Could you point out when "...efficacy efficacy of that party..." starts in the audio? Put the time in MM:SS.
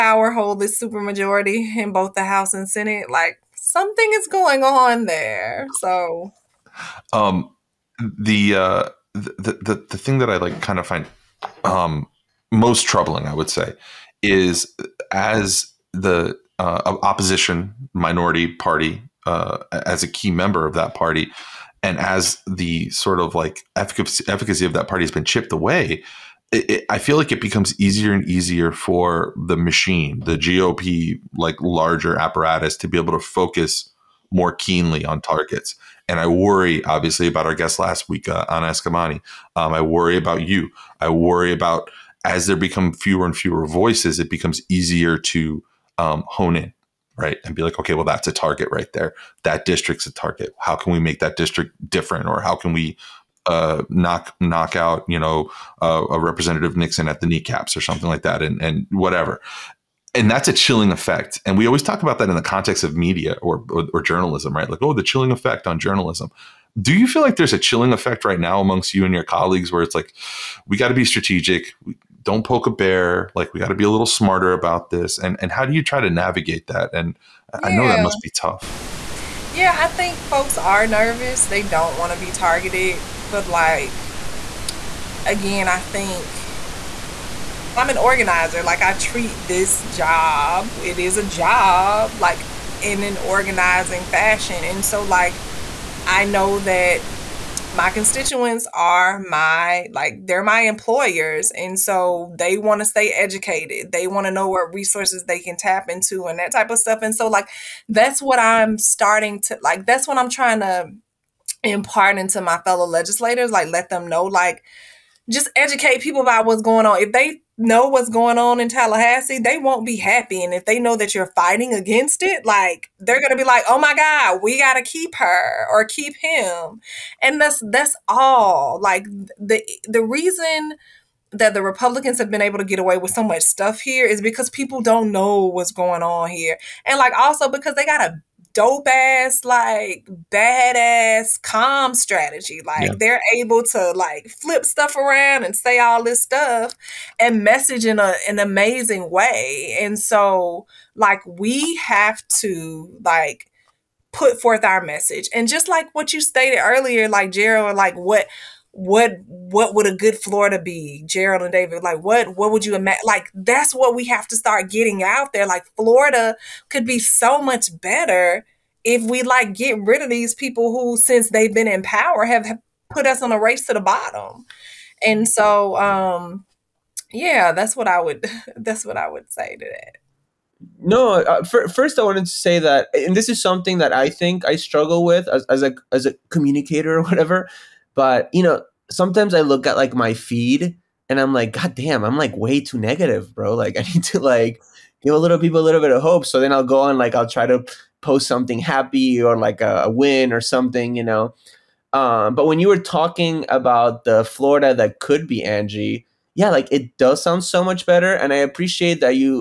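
00:23.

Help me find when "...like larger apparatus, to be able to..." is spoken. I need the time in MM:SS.
00:31.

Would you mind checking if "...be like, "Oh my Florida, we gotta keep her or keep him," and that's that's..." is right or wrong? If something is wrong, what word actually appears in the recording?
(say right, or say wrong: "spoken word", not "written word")
wrong: "God", not "Florida".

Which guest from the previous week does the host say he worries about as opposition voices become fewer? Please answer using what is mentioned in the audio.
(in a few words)
Anna Eskamani.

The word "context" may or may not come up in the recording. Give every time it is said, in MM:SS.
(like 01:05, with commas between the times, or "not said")
01:02.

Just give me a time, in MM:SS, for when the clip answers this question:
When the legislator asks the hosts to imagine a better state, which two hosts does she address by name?
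02:41.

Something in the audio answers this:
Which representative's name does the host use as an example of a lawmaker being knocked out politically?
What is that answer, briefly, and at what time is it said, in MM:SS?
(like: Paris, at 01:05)
Nixon, at 00:56.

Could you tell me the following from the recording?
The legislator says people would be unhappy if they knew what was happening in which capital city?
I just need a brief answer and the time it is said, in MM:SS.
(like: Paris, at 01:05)
Tallahassee, at 01:58.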